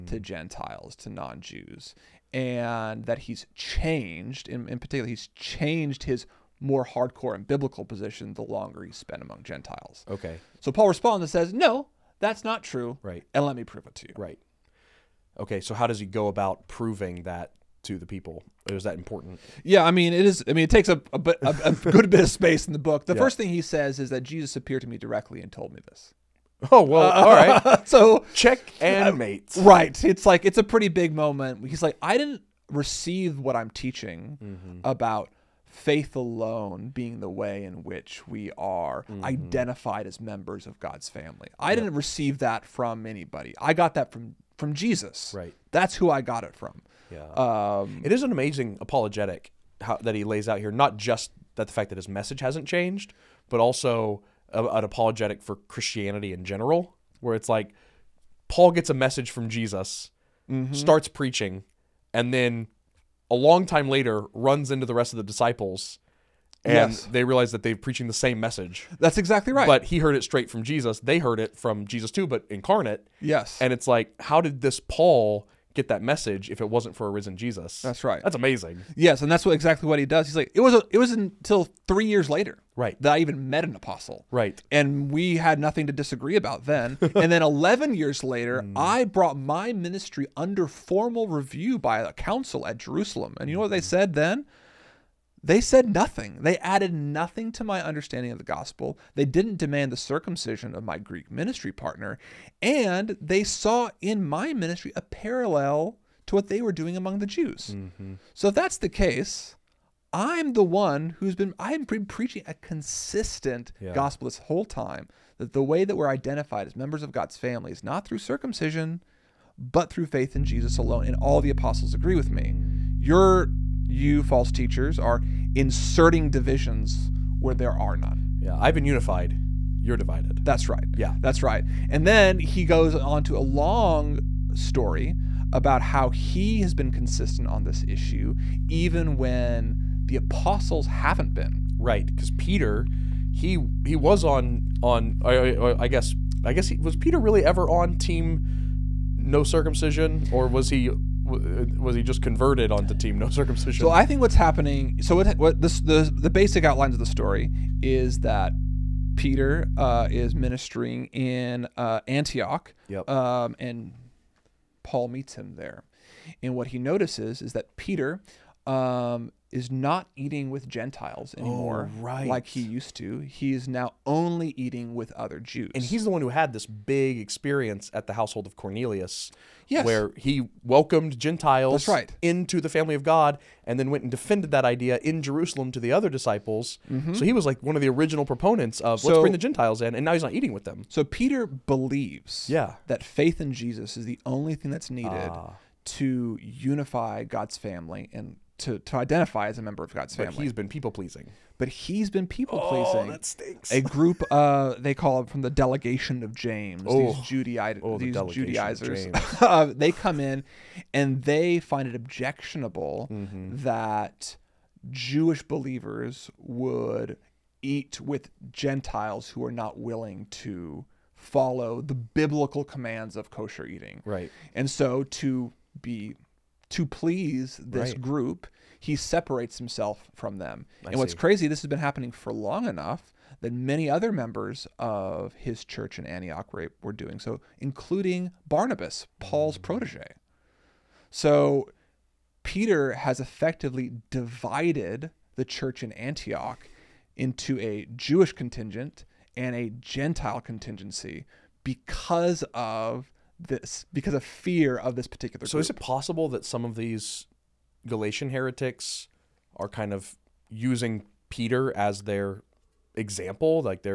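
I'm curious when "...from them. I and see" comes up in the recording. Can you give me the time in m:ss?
3:50.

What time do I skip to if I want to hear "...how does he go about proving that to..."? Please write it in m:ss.
0:15.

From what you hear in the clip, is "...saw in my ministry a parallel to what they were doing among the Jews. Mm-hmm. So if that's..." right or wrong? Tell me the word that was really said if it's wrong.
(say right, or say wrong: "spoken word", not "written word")
right.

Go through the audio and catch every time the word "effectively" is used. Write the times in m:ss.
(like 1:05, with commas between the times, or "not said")
4:03.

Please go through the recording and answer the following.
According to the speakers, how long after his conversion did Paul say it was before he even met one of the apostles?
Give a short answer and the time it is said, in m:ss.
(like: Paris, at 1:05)
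3 years, at 1:21.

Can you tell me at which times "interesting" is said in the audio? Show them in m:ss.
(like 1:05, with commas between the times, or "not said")
not said.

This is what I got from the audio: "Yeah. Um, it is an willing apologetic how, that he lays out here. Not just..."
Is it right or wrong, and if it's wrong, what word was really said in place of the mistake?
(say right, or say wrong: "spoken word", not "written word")
wrong: "amazing", not "willing".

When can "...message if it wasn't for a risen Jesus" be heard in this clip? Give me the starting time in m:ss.
1:16.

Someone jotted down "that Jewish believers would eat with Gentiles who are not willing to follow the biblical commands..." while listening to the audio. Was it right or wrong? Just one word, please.
right.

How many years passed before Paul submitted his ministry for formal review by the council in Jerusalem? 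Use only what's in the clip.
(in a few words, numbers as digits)
11 years.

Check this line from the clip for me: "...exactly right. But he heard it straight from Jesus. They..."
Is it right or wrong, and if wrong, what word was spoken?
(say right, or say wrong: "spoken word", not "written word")
right.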